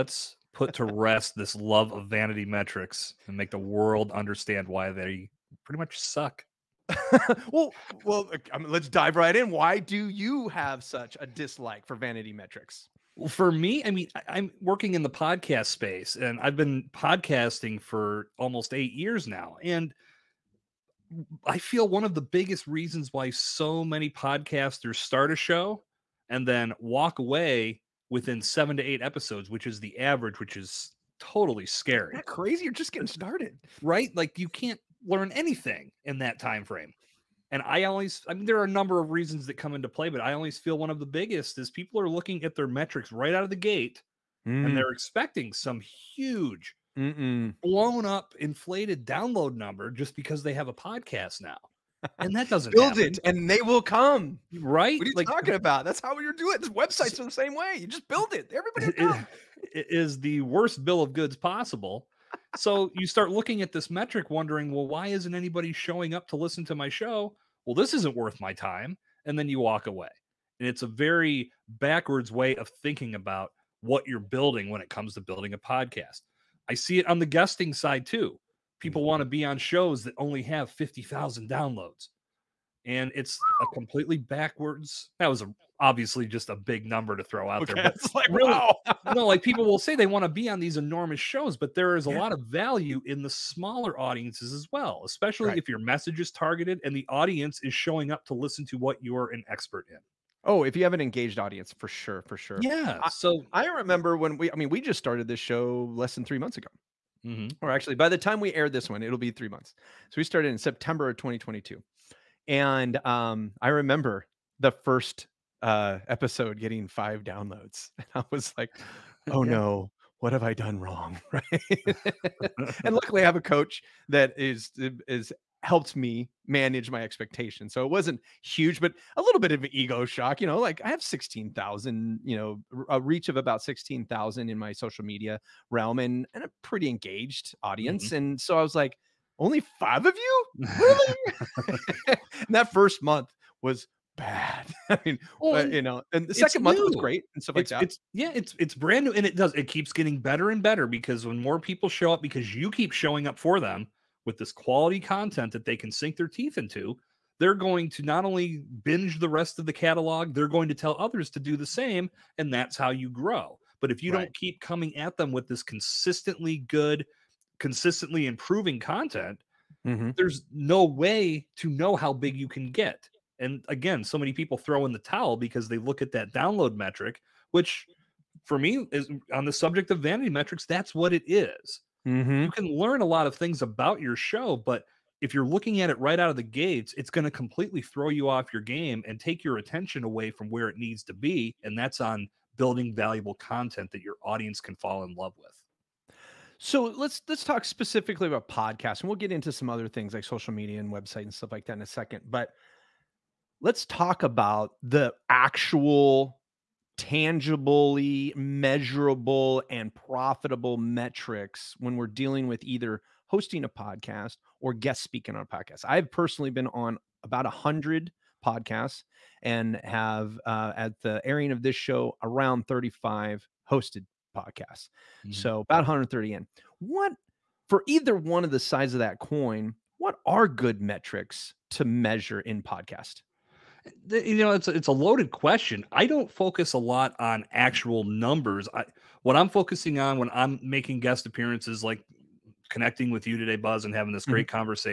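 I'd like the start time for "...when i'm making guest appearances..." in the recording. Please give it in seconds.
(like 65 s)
240 s.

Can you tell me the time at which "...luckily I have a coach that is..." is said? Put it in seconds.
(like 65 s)
122 s.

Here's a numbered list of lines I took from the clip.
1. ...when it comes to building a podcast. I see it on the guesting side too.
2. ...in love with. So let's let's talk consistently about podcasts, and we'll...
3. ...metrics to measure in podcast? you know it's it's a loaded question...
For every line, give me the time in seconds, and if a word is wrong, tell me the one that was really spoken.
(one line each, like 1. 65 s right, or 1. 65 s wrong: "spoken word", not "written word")
1. 74 s right
2. 195 s wrong: "specifically", not "consistently"
3. 230 s right.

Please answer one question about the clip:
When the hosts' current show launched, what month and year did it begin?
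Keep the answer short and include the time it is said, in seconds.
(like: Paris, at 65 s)
September 2022, at 110 s.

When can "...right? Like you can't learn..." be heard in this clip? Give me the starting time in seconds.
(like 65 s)
33 s.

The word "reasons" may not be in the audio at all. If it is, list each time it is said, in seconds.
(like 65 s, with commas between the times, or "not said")
22 s, 39 s.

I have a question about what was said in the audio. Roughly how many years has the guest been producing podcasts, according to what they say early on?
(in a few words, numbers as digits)
8.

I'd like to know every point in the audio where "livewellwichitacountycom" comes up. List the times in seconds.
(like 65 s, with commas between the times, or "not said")
not said.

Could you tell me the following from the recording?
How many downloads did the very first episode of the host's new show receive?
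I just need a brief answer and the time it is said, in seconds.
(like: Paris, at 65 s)
5, at 116 s.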